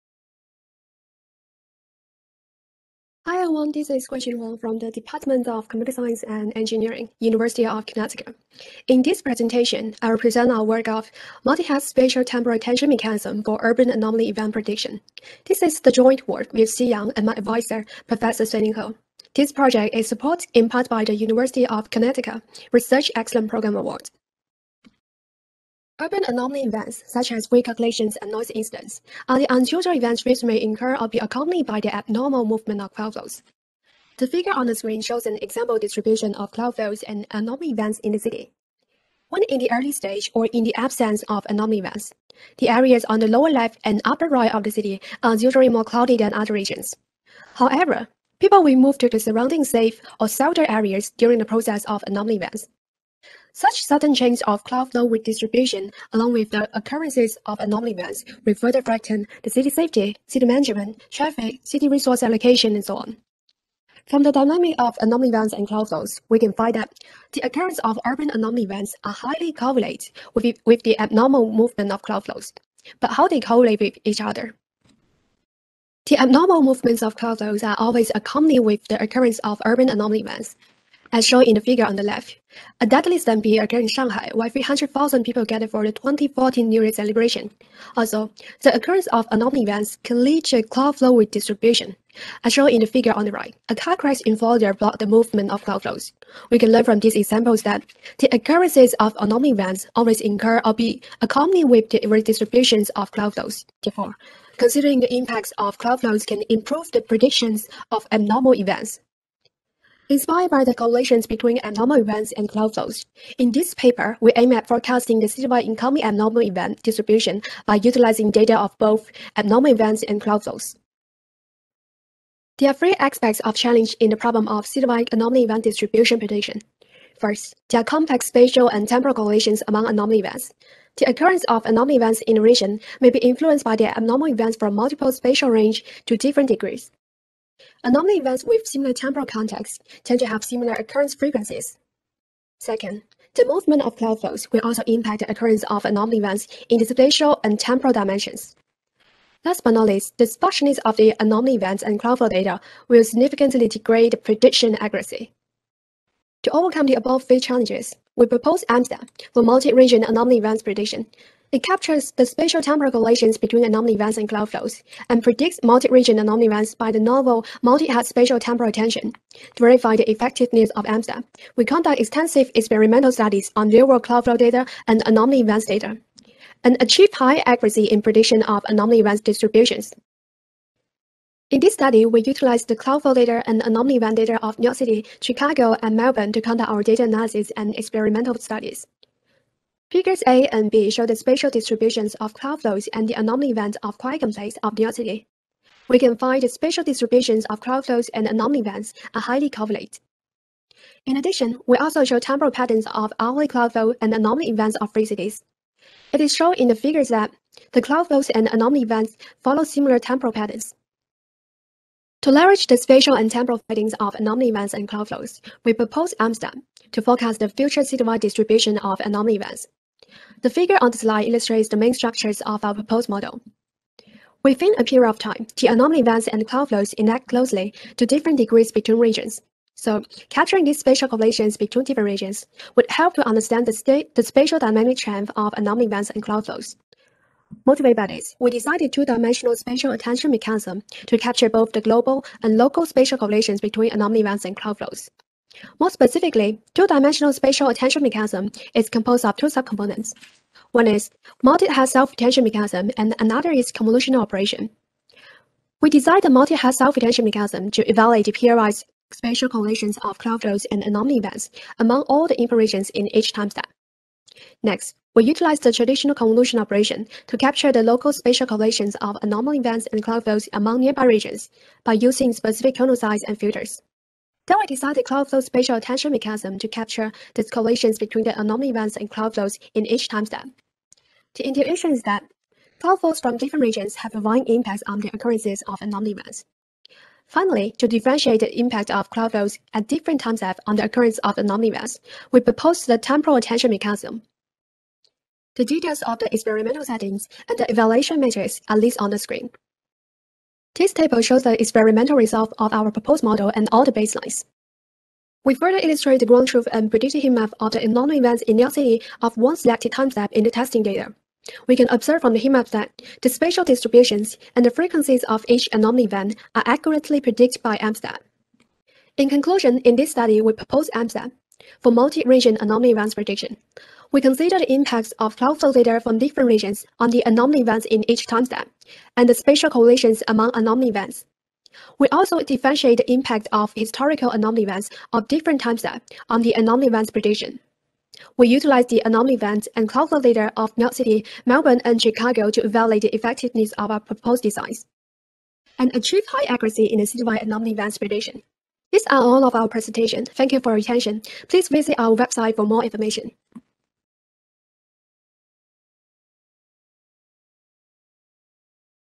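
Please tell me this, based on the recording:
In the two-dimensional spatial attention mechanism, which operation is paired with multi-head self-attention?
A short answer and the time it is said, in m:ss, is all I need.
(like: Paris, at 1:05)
convolutional operation, at 4:13.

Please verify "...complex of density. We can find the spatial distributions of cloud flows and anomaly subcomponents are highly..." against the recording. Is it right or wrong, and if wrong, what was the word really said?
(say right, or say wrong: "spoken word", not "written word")
wrong: "events", not "subcomponents".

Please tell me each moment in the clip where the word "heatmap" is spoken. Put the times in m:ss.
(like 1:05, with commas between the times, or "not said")
5:07, 5:12.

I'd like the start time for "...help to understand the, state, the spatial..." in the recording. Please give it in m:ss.
3:52.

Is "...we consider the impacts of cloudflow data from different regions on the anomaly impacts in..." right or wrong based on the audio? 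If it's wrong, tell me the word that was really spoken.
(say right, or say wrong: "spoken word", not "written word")
wrong: "events", not "impacts".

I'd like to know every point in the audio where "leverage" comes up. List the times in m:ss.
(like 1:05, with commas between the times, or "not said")
3:32.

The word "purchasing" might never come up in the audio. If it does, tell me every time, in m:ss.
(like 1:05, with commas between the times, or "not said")
not said.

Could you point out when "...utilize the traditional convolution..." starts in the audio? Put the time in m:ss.
4:25.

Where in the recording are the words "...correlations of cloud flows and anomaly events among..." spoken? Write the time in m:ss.
4:19.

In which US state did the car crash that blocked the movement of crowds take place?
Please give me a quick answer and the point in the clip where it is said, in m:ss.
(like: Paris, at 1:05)
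Florida, at 1:34.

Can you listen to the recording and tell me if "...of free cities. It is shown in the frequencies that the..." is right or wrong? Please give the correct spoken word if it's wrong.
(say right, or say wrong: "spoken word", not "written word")
wrong: "figures", not "frequencies".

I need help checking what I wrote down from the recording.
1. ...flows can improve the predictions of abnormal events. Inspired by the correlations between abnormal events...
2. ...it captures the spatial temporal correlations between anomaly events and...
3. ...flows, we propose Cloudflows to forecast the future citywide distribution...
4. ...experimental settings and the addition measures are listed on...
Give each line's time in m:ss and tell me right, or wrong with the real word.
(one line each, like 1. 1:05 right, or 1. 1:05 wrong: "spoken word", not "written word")
1. 1:45 right
2. 2:41 right
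3. 3:35 wrong: "Amsterdam", not "Cloudflows"
4. 4:56 wrong: "evaluation", not "addition".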